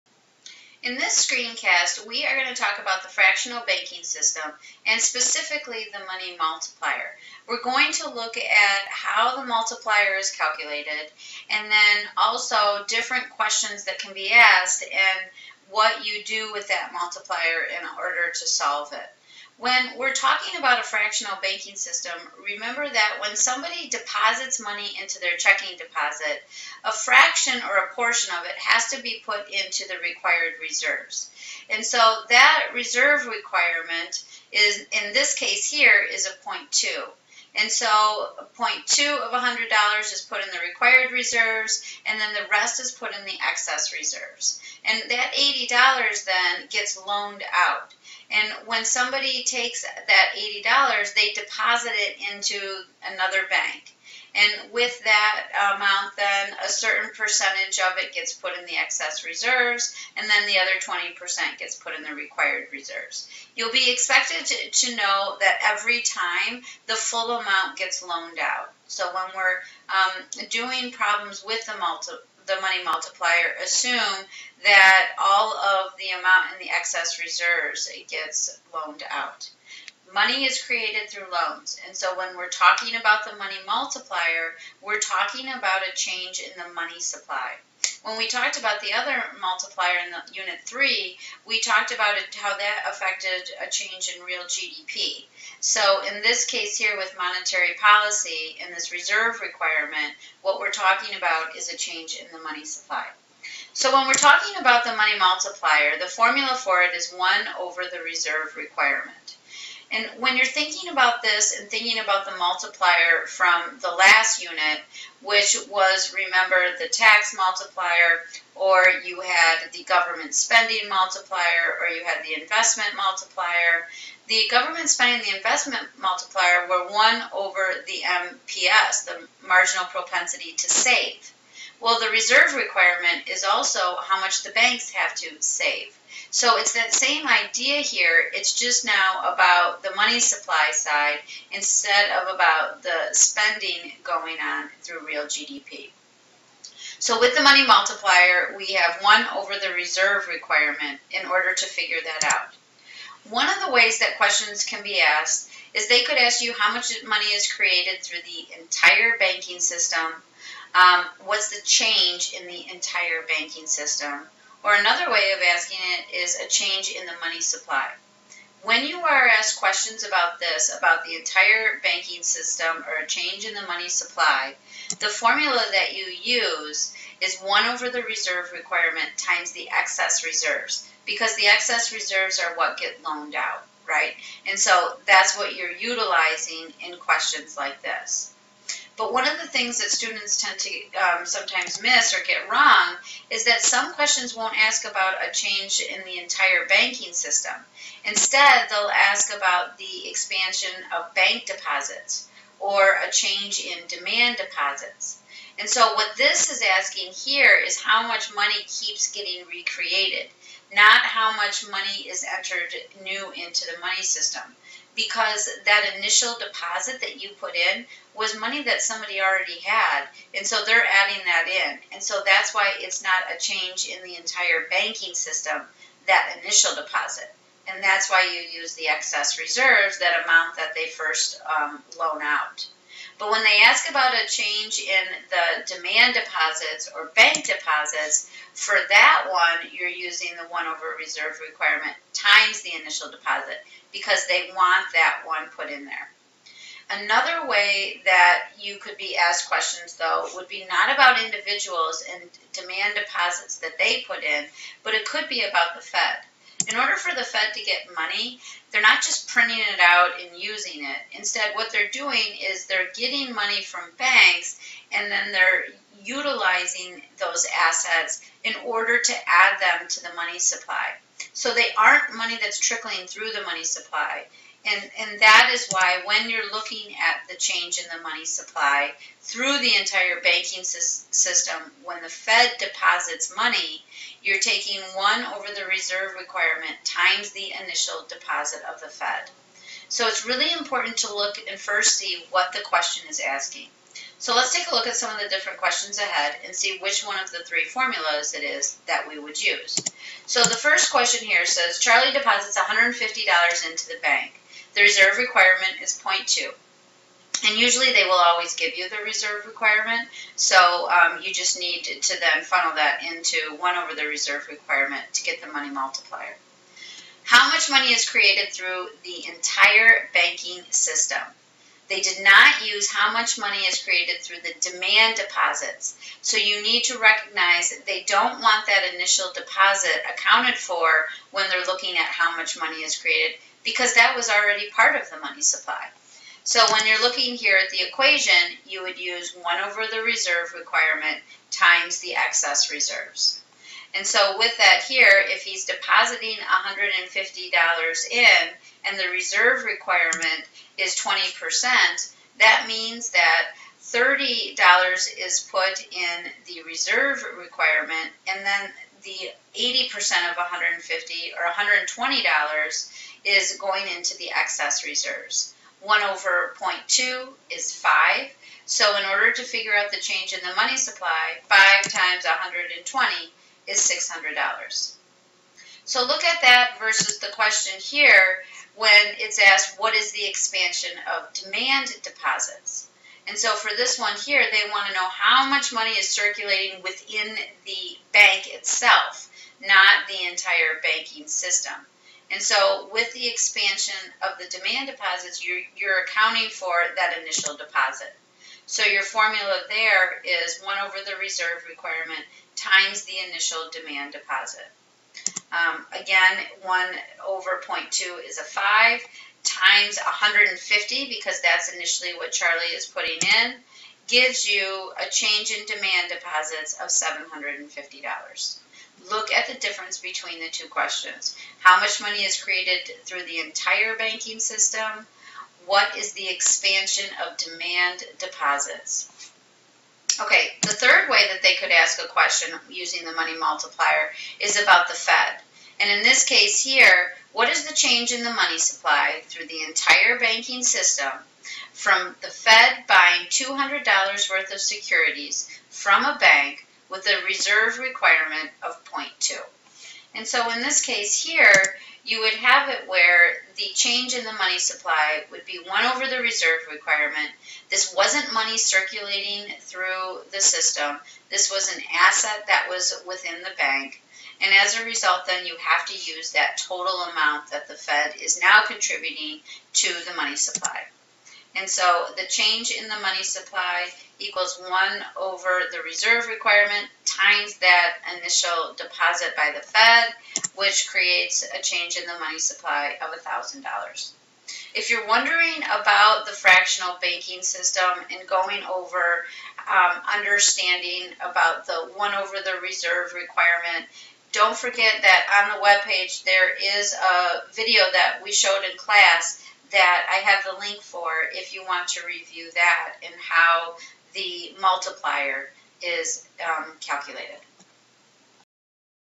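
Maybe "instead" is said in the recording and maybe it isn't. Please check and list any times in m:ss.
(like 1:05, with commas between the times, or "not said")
2:21, 3:18, 4:21.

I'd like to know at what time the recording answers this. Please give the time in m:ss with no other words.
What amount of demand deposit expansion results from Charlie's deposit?
6:56.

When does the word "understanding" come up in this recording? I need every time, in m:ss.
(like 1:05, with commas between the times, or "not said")
8:10.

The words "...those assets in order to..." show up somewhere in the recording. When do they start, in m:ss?
4:27.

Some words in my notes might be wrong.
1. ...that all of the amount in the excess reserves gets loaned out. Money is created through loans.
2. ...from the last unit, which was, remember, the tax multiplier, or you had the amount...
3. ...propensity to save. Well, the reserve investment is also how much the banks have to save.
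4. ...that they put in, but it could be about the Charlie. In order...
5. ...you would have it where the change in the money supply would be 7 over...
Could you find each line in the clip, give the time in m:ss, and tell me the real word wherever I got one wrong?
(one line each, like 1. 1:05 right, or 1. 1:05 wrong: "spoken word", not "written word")
1. 1:14 right
2. 1:53 wrong: "government", not "amount"
3. 2:09 wrong: "requirement", not "investment"
4. 4:13 wrong: "Fed", not "Charlie"
5. 7:32 wrong: "1", not "7".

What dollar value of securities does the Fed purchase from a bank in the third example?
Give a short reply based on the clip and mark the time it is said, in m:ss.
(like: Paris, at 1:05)
$200, at 7:23.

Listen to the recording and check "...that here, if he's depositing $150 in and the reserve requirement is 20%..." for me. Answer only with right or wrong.
right.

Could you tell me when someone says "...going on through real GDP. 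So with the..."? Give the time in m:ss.
2:24.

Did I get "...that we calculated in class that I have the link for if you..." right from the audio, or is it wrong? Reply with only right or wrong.
wrong.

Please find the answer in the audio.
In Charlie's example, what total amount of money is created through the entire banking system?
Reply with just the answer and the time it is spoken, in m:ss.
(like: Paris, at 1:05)
$600, at 6:13.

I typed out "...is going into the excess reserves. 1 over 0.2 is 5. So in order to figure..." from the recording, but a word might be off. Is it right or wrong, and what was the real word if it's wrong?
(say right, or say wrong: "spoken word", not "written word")
right.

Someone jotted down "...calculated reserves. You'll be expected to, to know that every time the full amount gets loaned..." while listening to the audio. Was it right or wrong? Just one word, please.
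wrong.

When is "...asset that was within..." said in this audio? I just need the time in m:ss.
7:41.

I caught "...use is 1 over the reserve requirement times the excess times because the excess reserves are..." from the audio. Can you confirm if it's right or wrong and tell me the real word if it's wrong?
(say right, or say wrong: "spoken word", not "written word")
wrong: "reserves", not "times".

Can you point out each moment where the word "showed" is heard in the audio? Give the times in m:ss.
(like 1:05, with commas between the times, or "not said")
8:18.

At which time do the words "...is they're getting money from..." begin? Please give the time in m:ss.
4:22.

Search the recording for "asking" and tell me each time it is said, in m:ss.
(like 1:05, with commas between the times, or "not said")
2:45, 3:26, 4:53.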